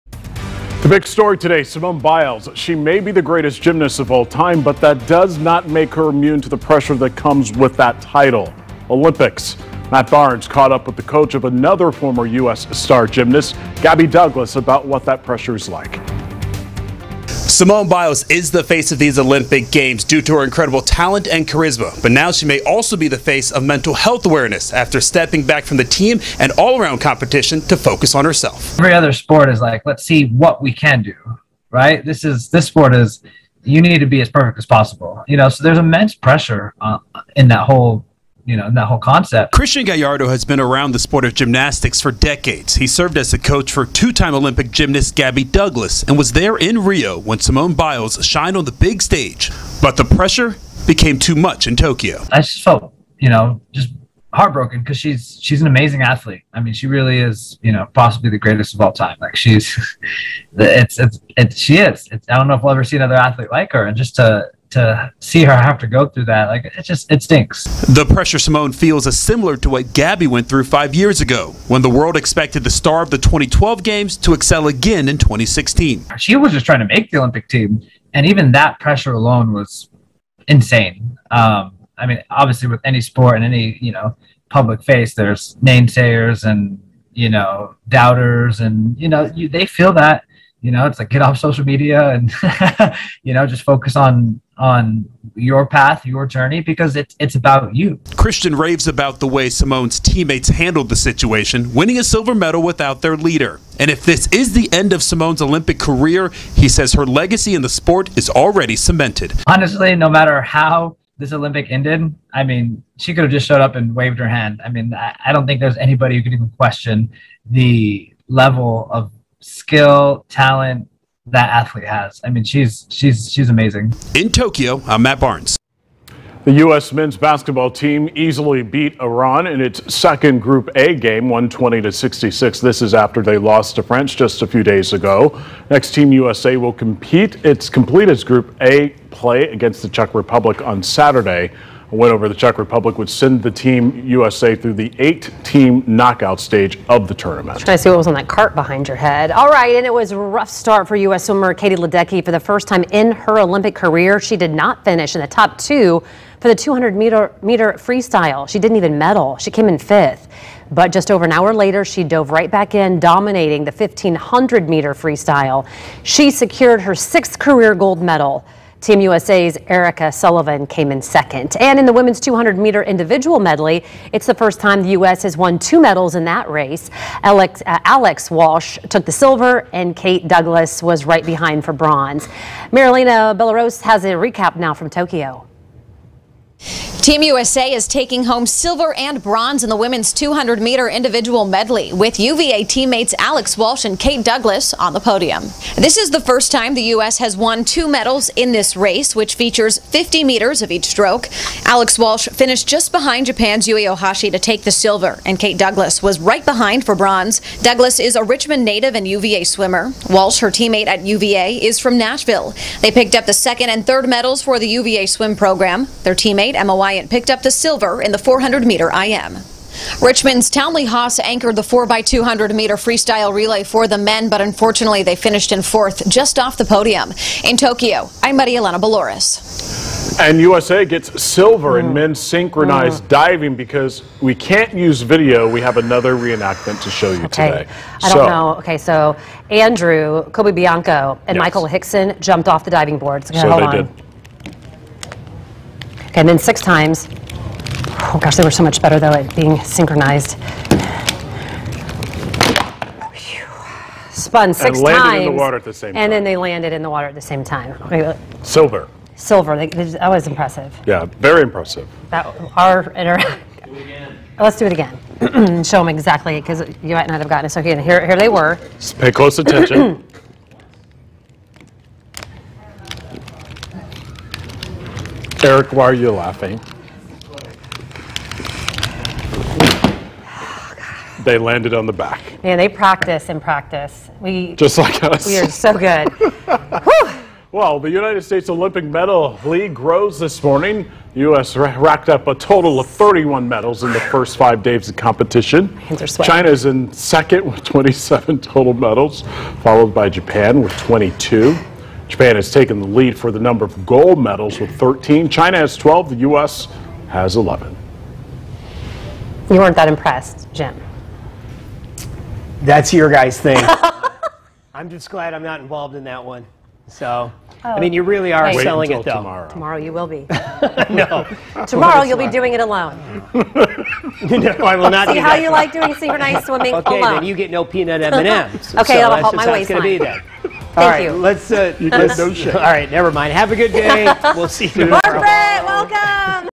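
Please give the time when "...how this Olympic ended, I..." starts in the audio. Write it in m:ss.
1:50.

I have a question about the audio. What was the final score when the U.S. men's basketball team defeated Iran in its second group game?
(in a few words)
120 to 66.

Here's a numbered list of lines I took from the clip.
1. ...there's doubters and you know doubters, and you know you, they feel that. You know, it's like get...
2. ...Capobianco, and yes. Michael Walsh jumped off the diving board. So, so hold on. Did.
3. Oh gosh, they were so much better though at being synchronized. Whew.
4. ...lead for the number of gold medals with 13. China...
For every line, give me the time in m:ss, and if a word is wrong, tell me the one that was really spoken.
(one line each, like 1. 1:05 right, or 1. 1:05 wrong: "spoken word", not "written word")
1. 1:25 wrong: "namesayers", not "doubters"
2. 4:00 wrong: "Hixon", not "Walsh"
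3. 4:08 right
4. 5:02 right.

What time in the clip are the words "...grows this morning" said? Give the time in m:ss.
4:49.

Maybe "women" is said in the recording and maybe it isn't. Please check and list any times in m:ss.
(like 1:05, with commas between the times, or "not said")
2:51, 3:09.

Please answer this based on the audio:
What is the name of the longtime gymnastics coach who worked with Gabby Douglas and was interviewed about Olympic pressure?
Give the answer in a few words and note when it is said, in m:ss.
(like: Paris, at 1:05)
Christian Gallardo, at 0:39.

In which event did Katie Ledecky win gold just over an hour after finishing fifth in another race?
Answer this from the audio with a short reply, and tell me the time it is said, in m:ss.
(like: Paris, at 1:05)
1500 meter freestyle, at 2:43.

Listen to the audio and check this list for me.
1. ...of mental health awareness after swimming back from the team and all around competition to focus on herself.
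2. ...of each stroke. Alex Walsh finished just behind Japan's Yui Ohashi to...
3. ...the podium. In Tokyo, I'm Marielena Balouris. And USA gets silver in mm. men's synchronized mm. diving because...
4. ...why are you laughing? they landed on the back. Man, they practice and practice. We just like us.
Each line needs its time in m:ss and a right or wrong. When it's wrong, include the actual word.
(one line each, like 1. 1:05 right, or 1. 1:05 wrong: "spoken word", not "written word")
1. 0:23 wrong: "stepping", not "swimming"
2. 3:20 right
3. 3:46 right
4. 4:35 right.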